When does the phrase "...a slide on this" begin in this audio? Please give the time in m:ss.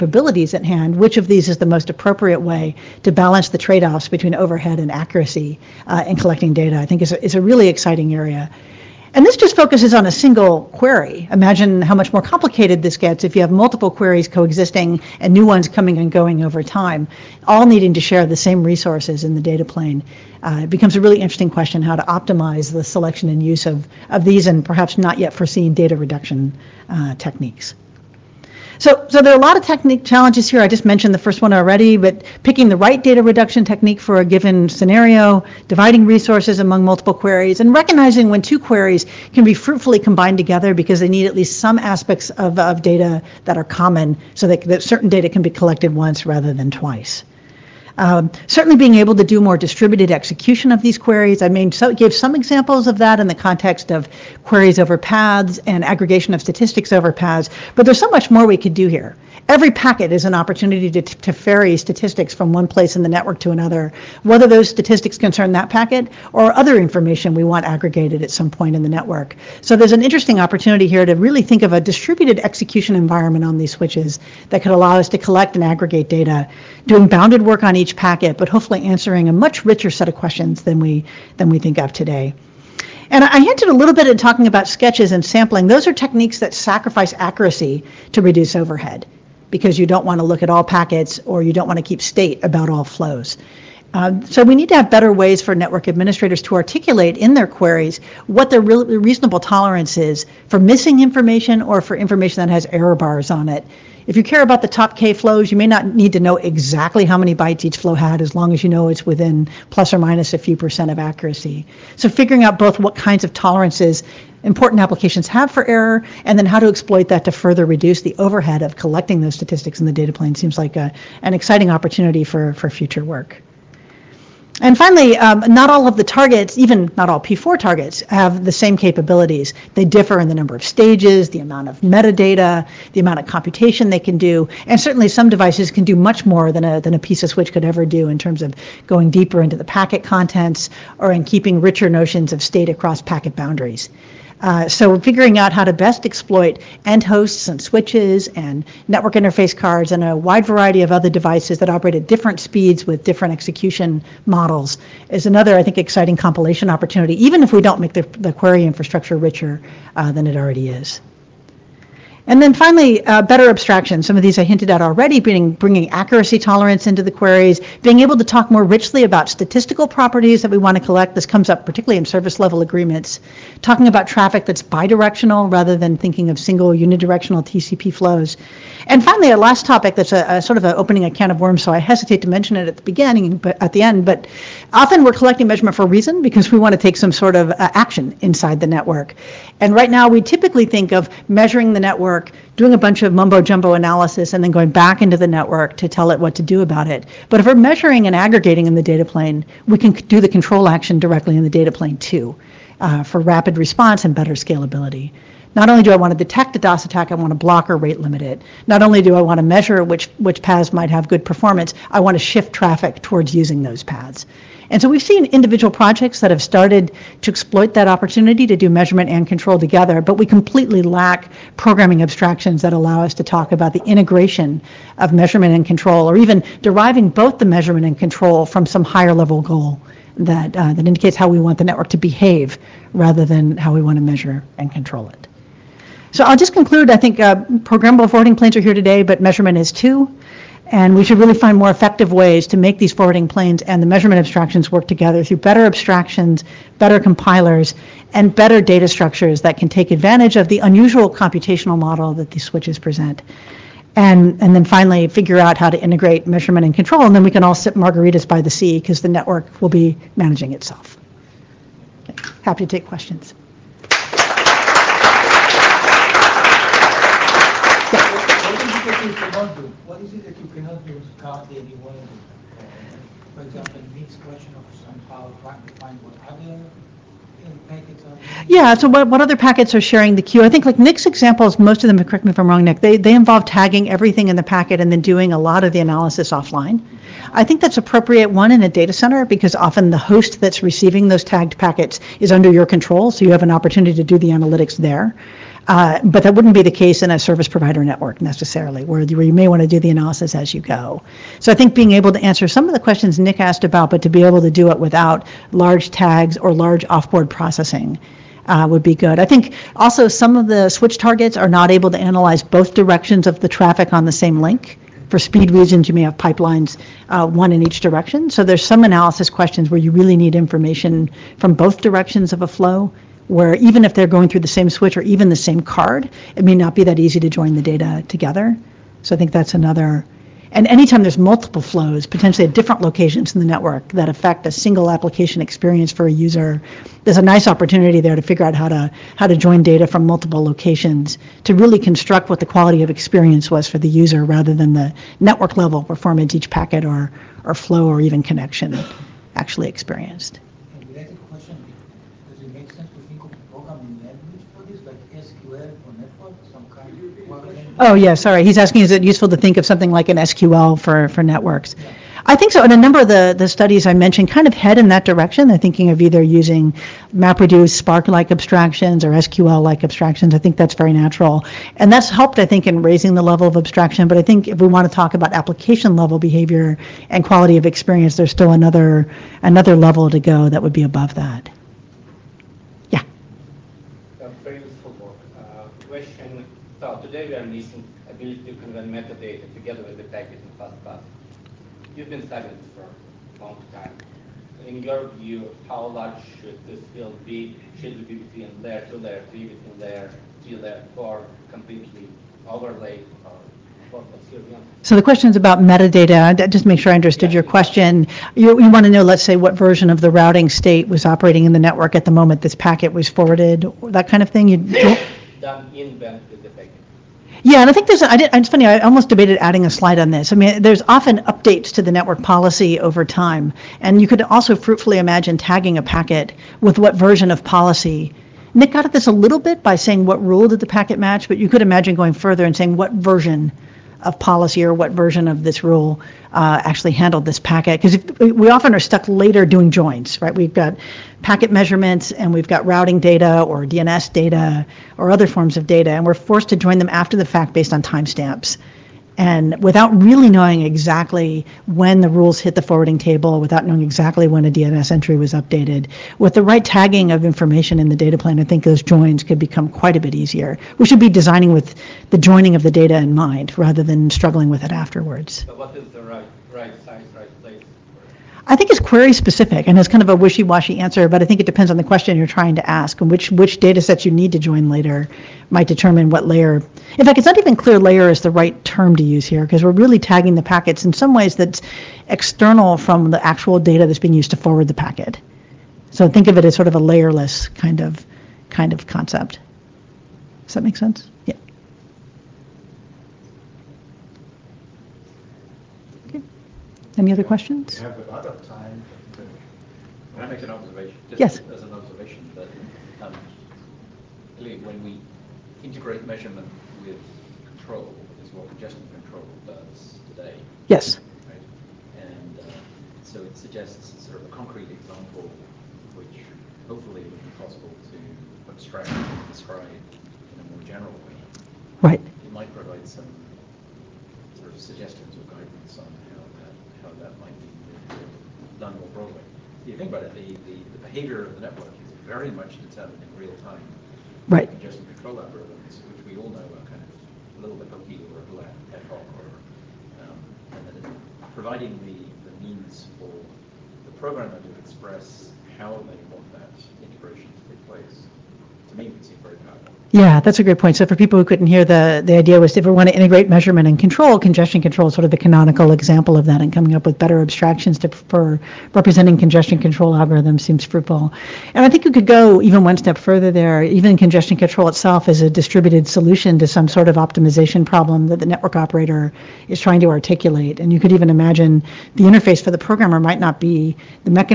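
6:59.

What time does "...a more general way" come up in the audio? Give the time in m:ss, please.
8:40.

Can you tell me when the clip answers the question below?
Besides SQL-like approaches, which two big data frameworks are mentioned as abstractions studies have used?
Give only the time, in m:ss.
6:07.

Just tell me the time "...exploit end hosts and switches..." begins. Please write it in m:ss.
2:26.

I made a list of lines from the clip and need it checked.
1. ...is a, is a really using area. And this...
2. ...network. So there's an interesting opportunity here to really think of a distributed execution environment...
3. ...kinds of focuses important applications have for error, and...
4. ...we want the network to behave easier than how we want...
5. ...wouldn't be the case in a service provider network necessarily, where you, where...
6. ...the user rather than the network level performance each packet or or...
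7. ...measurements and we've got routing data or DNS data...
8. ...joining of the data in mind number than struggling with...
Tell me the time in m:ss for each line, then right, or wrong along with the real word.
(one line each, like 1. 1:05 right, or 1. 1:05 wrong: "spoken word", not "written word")
1. 0:07 wrong: "exciting", not "using"
2. 1:08 right
3. 1:52 wrong: "tolerances", not "focuses"
4. 3:51 wrong: "rather", not "easier"
5. 4:56 right
6. 5:43 right
7. 7:21 right
8. 7:42 wrong: "rather", not "number".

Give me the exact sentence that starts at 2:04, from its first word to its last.
And finally, um, not all of the targets, even not all P4 targets, have the same capabilities.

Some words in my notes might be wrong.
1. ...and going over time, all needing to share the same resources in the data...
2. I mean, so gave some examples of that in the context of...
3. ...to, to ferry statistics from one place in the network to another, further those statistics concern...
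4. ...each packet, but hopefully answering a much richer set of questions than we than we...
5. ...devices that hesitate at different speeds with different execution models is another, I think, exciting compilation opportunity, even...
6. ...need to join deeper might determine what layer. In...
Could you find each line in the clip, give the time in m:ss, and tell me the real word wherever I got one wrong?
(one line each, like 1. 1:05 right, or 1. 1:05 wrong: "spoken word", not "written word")
1. 0:15 right
2. 0:51 right
3. 1:00 wrong: "whether", not "further"
4. 1:17 right
5. 2:31 wrong: "operate", not "hesitate"
6. 7:54 wrong: "later", not "deeper".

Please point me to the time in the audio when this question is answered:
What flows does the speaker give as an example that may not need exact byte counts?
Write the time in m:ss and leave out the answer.
1:44.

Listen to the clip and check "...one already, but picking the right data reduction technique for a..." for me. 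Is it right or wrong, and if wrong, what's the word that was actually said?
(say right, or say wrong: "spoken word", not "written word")
right.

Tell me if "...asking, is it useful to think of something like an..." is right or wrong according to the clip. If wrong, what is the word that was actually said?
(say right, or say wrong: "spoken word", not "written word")
right.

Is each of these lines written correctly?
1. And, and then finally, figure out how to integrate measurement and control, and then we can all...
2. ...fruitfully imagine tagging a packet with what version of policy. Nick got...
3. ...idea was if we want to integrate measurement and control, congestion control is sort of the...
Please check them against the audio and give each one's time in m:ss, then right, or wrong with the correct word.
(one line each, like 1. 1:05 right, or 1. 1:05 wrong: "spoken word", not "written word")
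1. 4:13 right
2. 7:04 right
3. 9:12 right.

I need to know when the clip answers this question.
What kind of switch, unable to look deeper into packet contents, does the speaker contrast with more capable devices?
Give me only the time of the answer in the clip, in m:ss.
2:16.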